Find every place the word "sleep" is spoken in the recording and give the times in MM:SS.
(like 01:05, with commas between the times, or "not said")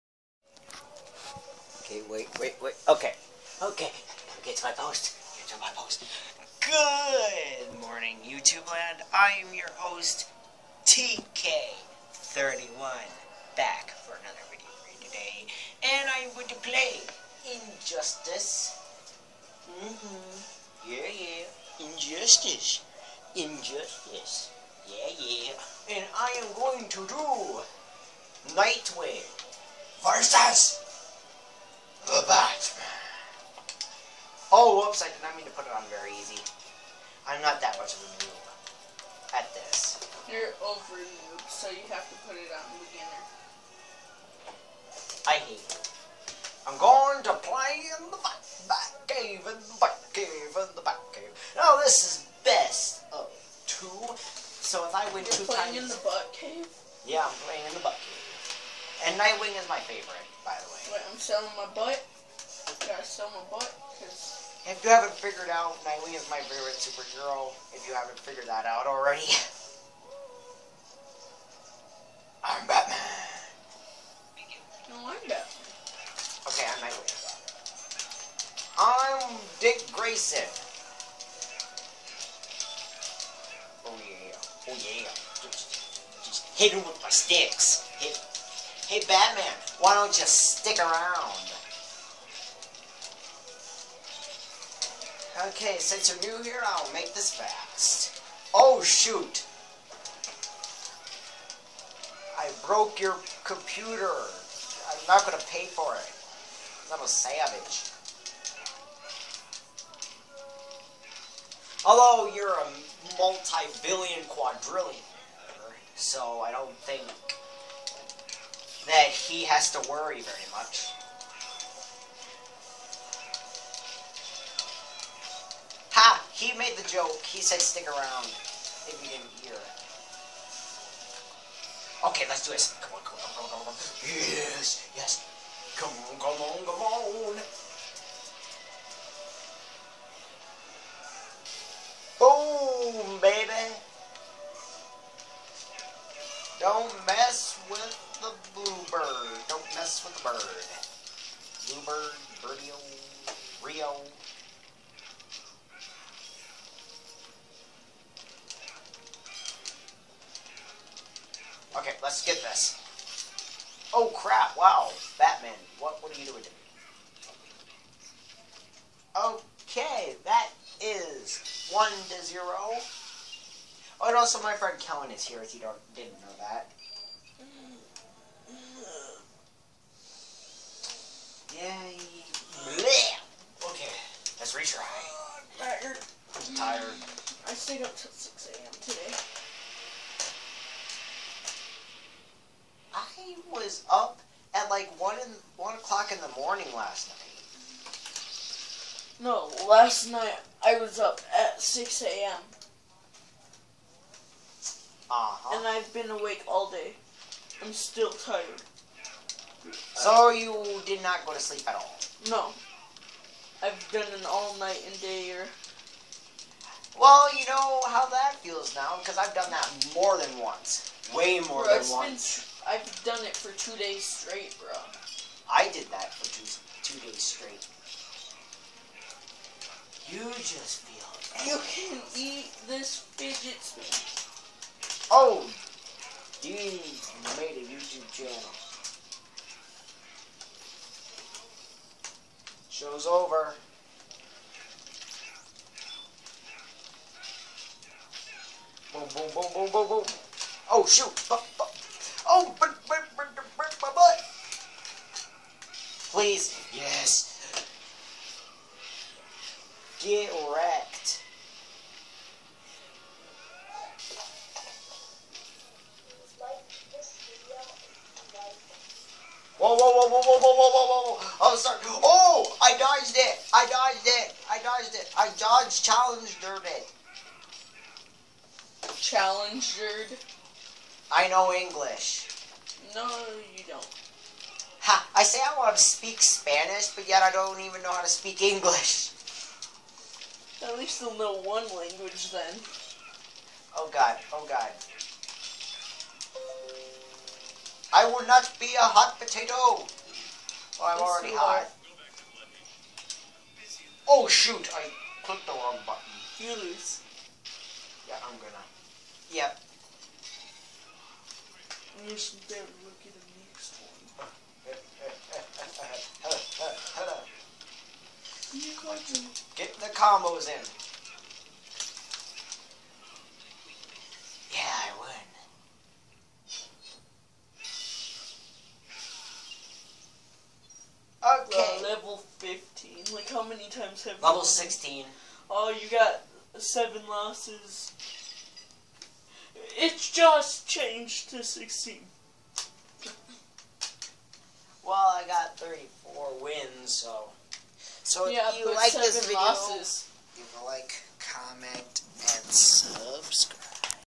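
03:31.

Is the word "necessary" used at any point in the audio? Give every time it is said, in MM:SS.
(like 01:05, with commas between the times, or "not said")
not said.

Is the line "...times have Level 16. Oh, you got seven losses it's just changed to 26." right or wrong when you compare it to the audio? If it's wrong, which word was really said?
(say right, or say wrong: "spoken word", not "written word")
wrong: "16", not "26".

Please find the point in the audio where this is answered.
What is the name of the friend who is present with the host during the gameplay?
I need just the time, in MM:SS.
02:54.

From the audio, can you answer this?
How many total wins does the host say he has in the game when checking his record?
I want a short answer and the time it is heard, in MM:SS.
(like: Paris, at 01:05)
34, at 05:45.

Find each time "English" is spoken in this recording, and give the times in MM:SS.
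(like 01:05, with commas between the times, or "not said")
04:41, 04:48.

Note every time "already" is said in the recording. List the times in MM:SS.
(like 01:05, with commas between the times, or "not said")
01:08, 05:01.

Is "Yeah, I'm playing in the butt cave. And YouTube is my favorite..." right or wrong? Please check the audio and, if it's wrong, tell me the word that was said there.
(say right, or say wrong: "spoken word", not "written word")
wrong: "Nightwing", not "YouTube".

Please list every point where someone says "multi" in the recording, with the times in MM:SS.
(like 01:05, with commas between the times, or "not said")
01:53.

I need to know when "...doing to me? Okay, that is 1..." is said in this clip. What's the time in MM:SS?
02:46.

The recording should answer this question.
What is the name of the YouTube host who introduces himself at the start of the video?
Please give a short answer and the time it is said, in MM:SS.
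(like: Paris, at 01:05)
TK31, at 00:10.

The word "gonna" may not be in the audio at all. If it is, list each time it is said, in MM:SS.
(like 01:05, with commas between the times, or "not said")
01:45, 05:08.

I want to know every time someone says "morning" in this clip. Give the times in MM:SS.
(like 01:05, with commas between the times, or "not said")
00:07, 03:16.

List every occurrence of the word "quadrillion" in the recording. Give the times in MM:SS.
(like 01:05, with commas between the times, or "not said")
01:54.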